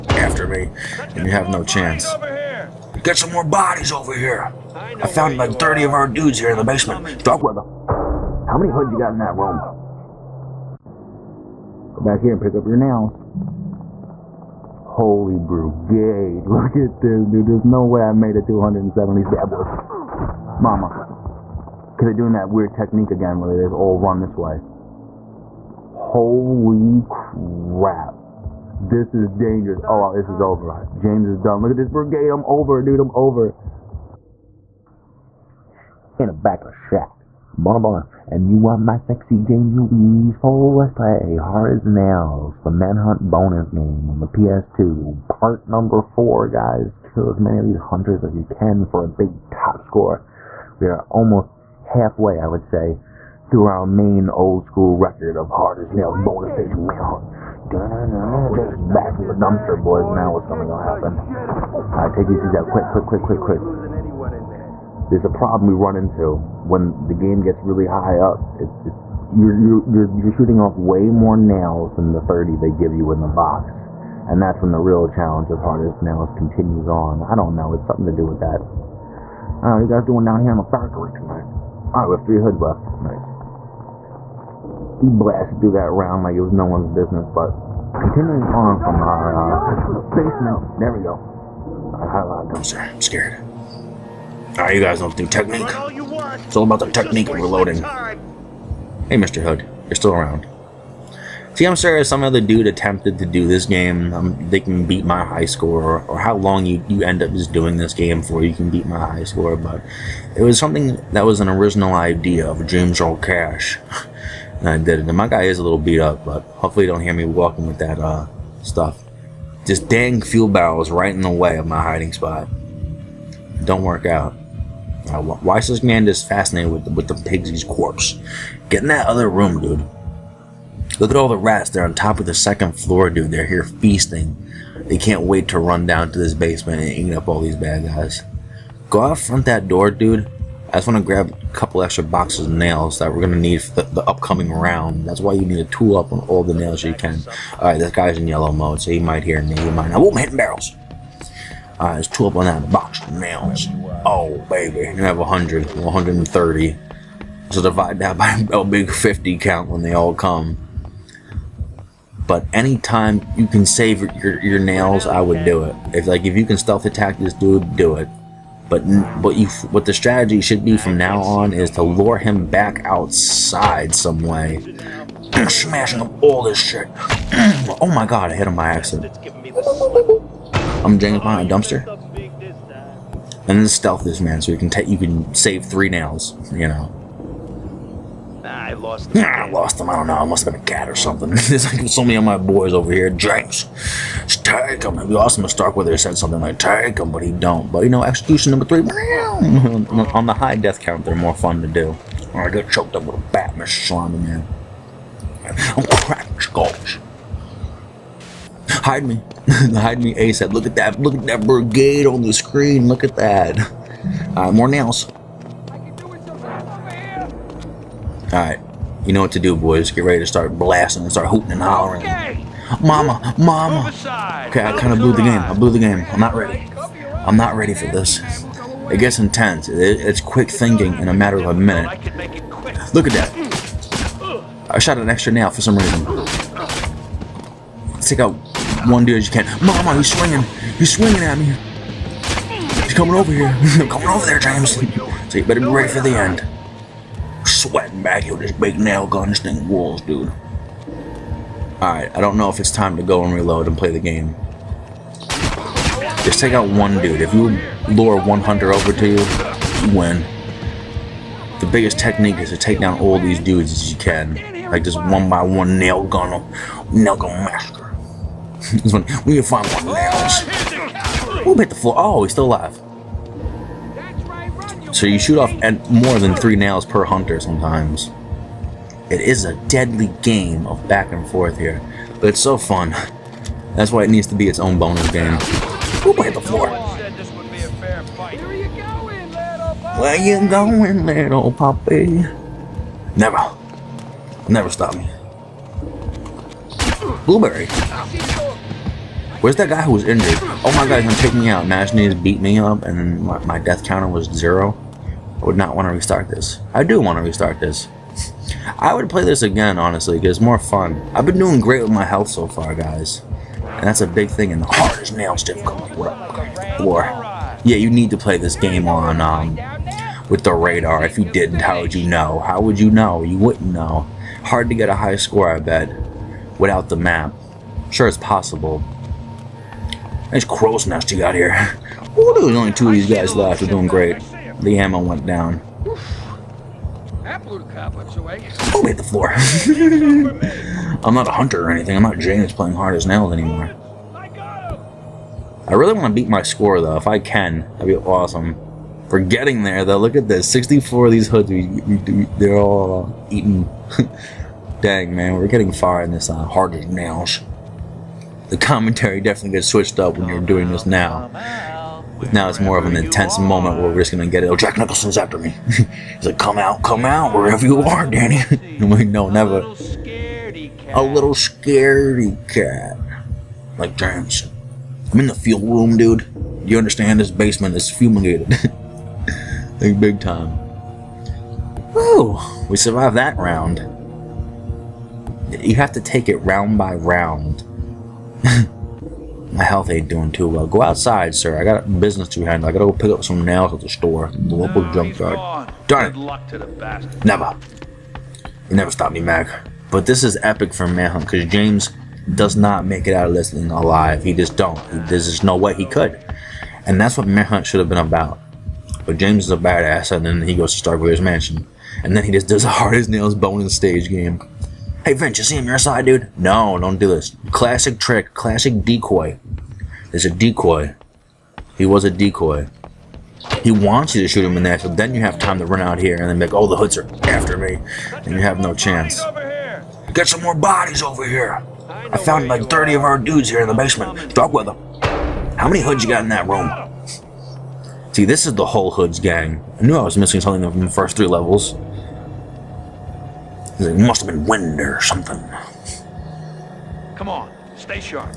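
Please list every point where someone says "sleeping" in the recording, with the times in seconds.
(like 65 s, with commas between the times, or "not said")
not said.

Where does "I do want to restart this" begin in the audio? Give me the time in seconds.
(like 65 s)
306 s.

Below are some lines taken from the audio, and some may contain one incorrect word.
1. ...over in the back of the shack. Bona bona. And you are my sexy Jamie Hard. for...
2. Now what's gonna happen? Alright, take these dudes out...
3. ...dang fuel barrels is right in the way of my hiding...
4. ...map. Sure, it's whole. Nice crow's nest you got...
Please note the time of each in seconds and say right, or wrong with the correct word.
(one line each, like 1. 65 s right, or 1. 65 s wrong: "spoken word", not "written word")
1. 33 s wrong: "Wees", not "Hard"
2. 60 s right
3. 119 s right
4. 326 s wrong: "possible", not "whole".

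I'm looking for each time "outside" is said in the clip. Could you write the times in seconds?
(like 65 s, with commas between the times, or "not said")
172 s, 390 s.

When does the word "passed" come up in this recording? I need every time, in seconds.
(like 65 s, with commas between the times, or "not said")
not said.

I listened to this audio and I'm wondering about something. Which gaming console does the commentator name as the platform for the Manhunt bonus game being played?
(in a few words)
PS2.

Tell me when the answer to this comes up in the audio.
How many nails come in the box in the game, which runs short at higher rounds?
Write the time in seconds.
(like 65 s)
72 s.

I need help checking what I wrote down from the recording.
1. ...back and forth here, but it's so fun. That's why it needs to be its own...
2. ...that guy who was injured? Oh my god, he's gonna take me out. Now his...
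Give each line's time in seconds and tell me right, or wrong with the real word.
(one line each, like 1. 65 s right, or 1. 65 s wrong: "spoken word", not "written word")
1. 280 s right
2. 299 s right.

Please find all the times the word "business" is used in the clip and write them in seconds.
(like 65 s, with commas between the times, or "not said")
86 s, 391 s.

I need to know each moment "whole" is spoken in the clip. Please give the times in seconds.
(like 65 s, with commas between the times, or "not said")
438 s.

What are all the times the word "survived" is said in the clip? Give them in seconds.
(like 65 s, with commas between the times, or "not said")
382 s.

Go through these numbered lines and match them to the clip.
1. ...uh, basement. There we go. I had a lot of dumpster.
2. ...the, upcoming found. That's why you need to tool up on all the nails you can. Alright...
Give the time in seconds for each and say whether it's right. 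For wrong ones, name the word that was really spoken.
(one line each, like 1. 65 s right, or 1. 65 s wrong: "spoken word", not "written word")
1. 89 s right
2. 143 s wrong: "round", not "found".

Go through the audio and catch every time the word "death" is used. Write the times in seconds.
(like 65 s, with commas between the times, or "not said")
200 s, 303 s.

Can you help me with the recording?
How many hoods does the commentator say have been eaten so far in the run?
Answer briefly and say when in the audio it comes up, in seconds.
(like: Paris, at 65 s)
64, at 350 s.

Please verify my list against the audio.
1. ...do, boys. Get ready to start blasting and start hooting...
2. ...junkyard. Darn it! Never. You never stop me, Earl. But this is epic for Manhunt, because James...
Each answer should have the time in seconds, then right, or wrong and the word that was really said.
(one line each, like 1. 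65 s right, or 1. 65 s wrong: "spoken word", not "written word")
1. 219 s right
2. 394 s wrong: "Mac", not "Earl".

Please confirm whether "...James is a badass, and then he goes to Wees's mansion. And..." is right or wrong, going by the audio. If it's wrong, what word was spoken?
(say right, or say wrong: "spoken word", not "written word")
wrong: "Starkweather", not "Wees".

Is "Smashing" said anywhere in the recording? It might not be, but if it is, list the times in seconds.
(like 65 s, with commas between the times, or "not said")
175 s.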